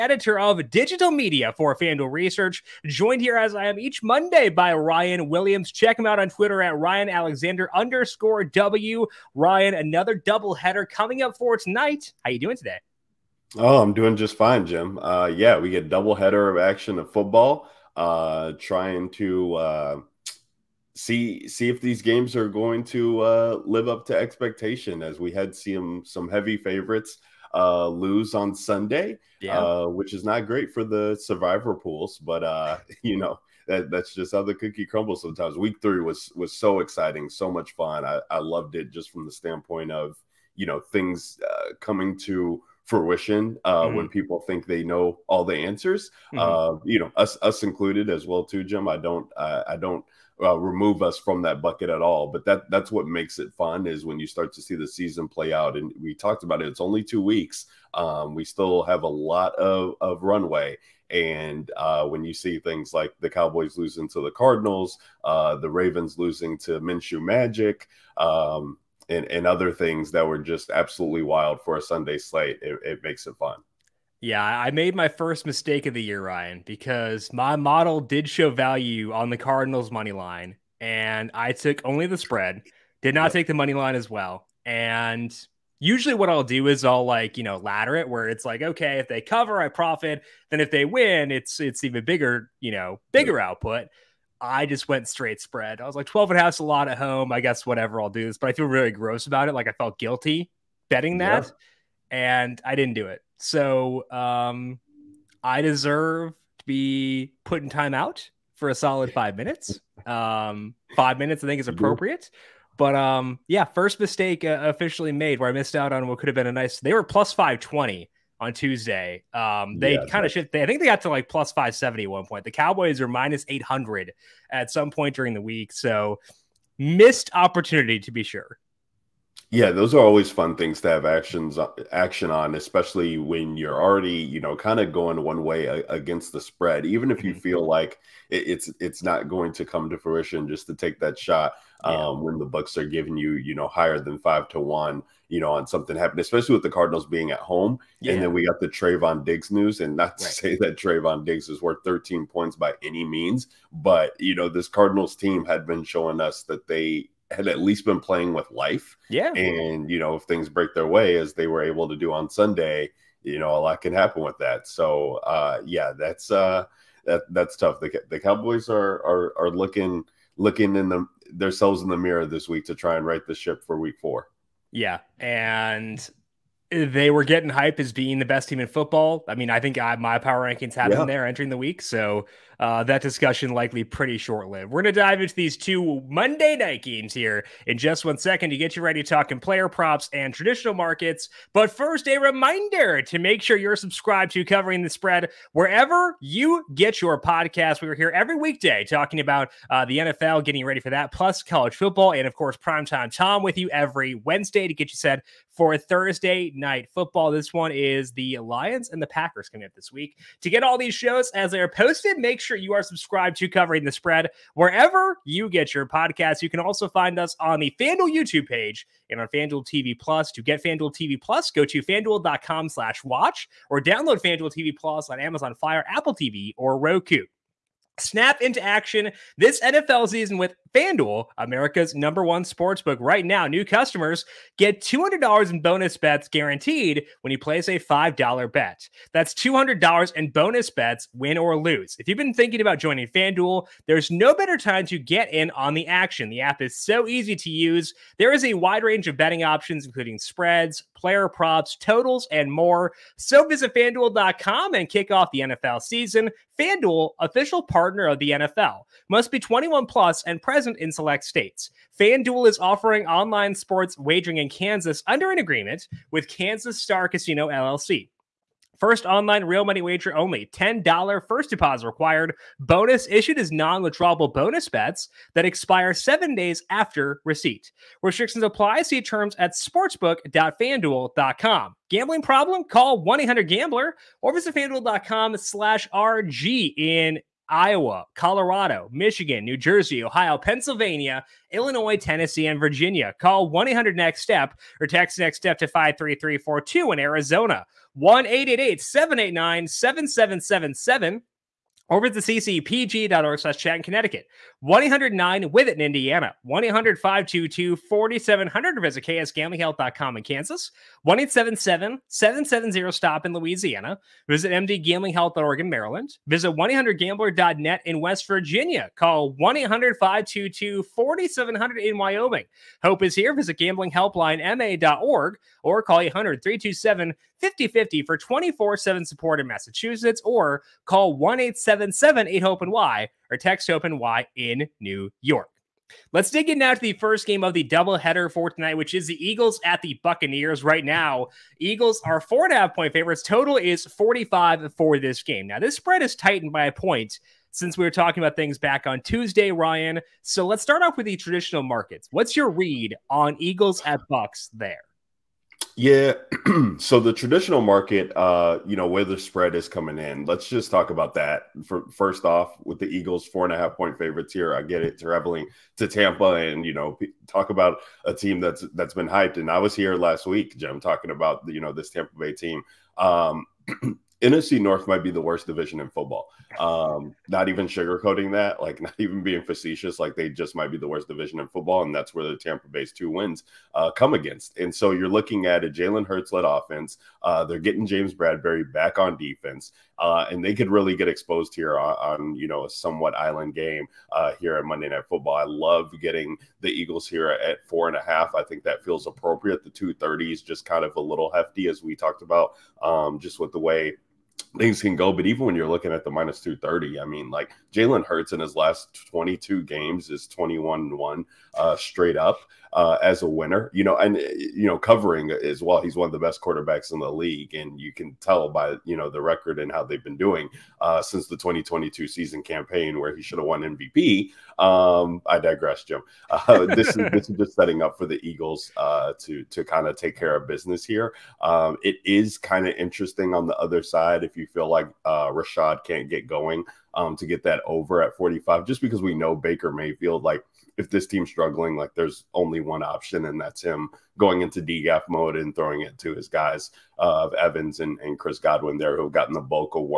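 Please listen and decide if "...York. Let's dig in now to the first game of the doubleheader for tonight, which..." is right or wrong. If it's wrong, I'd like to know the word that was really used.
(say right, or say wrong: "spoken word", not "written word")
right.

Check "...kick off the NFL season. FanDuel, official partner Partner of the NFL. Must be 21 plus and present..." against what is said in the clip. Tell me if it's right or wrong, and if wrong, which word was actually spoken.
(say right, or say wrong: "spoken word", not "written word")
right.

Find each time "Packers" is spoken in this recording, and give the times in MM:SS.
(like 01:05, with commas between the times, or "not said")
03:29.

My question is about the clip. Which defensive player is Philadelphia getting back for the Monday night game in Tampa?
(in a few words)
James Bradberry.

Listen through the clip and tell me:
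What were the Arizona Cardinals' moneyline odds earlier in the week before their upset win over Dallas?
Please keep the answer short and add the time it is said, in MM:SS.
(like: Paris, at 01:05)
+520, at 01:57.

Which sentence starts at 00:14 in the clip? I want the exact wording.
Uh, yeah, we get doubleheader of action of football.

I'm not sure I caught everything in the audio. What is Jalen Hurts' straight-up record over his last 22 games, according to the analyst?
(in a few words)
21-1.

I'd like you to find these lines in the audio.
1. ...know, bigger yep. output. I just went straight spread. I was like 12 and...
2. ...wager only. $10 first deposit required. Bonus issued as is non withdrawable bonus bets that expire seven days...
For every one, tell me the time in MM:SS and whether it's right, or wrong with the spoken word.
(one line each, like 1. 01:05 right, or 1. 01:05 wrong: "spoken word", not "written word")
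1. 01:32 right
2. 04:29 right.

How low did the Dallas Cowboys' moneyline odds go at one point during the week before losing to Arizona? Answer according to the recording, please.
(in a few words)
-800.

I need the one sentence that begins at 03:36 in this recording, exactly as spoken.
You can also find us on the FanDuel YouTube page and on FanDuel TV Plus.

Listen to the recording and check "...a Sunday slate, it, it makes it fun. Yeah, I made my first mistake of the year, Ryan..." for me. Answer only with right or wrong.
right.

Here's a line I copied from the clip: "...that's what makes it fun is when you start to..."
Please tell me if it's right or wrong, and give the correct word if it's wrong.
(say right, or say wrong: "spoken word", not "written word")
right.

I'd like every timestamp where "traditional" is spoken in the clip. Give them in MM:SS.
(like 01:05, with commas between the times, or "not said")
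03:10, 05:51, 05:57.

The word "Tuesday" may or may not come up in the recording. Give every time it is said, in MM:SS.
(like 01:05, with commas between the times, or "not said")
01:58, 05:49.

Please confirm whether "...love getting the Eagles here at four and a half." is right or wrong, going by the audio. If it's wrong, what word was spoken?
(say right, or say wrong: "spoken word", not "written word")
right.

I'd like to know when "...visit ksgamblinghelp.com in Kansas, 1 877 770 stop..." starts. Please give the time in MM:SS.
05:08.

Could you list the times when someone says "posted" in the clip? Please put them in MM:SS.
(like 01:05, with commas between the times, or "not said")
03:31.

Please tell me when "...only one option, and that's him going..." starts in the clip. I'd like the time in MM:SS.
07:22.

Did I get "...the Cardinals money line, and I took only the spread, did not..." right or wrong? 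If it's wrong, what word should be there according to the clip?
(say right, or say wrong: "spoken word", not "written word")
right.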